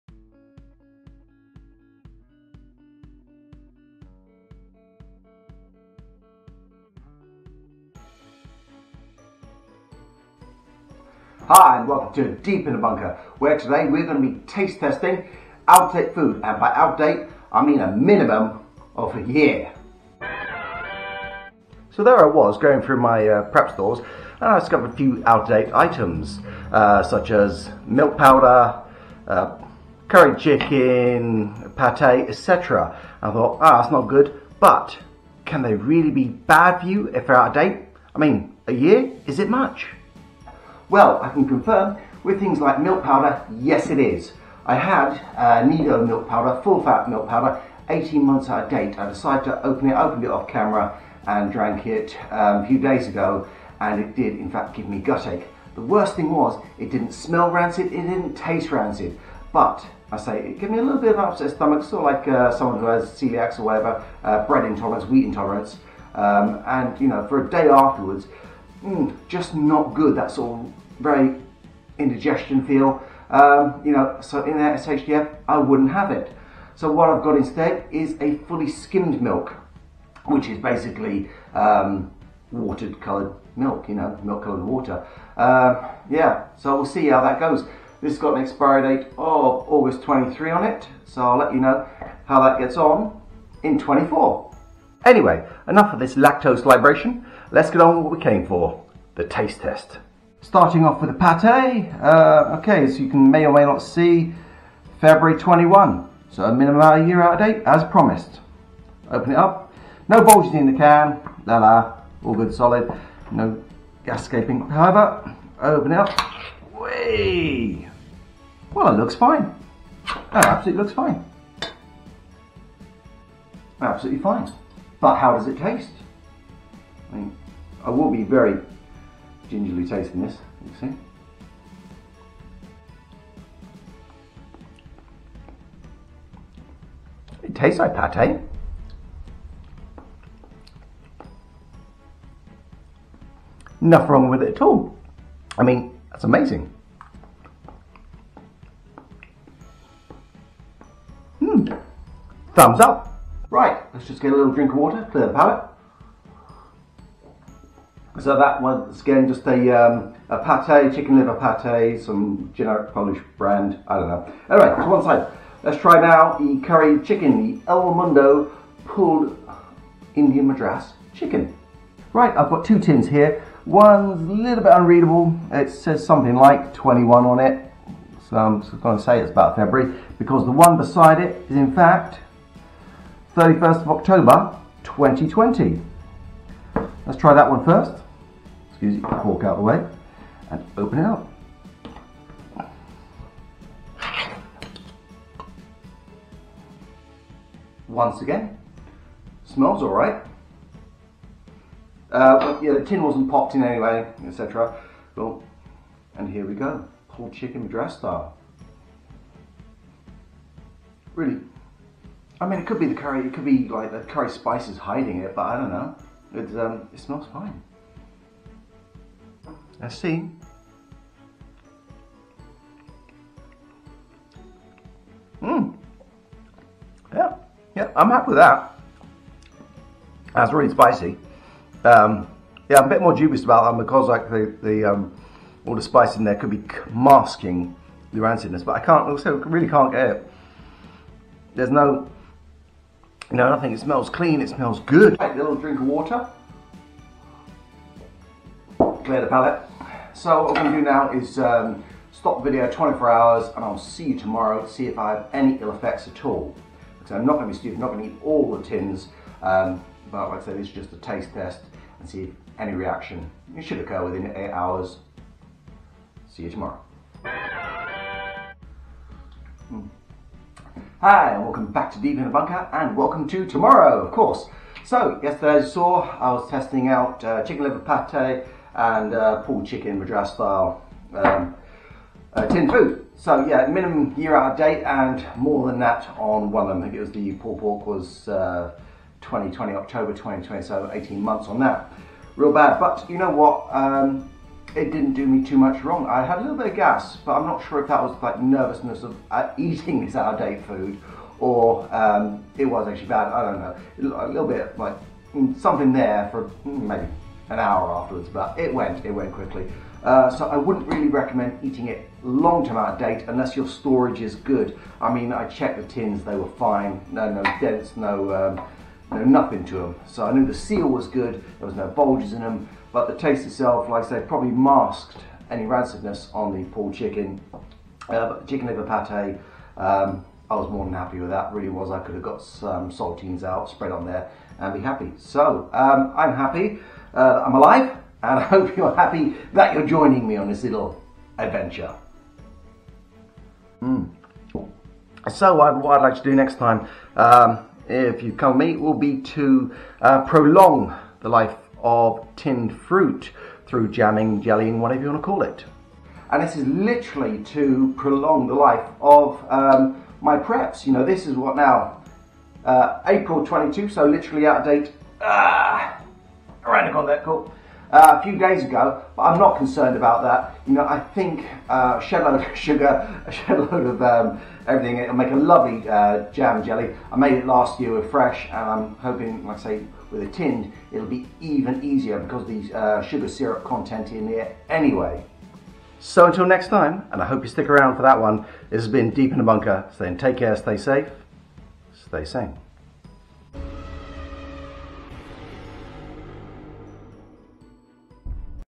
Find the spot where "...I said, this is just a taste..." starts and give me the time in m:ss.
4:20.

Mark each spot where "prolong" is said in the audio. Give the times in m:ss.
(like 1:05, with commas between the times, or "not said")
5:50, 5:57.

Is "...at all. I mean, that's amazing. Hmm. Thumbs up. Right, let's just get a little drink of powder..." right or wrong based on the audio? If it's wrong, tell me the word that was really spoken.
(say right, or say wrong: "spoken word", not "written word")
wrong: "water", not "powder".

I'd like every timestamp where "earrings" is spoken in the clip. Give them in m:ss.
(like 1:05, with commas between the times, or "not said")
not said.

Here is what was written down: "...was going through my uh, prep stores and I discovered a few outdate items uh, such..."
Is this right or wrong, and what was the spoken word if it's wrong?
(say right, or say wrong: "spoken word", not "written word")
right.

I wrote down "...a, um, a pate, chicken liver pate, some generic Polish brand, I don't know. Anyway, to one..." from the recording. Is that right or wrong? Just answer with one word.
right.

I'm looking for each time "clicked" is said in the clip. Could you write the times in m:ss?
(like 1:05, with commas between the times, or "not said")
not said.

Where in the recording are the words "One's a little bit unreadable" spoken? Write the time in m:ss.
2:53.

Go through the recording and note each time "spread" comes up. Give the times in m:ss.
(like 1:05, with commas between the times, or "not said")
5:33.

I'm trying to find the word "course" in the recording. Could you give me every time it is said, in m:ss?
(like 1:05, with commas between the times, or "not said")
4:34.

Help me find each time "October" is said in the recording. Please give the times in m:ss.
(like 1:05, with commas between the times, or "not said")
3:03, 4:49.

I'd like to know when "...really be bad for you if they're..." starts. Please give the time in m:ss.
0:35.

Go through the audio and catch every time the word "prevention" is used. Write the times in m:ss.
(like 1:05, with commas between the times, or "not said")
not said.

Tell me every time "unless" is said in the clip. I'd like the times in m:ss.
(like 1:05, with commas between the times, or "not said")
5:13.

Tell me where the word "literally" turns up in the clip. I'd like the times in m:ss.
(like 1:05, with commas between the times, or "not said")
5:56, 6:04.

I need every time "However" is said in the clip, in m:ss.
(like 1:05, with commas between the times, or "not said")
1:54.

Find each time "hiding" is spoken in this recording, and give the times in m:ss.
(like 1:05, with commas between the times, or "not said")
3:34.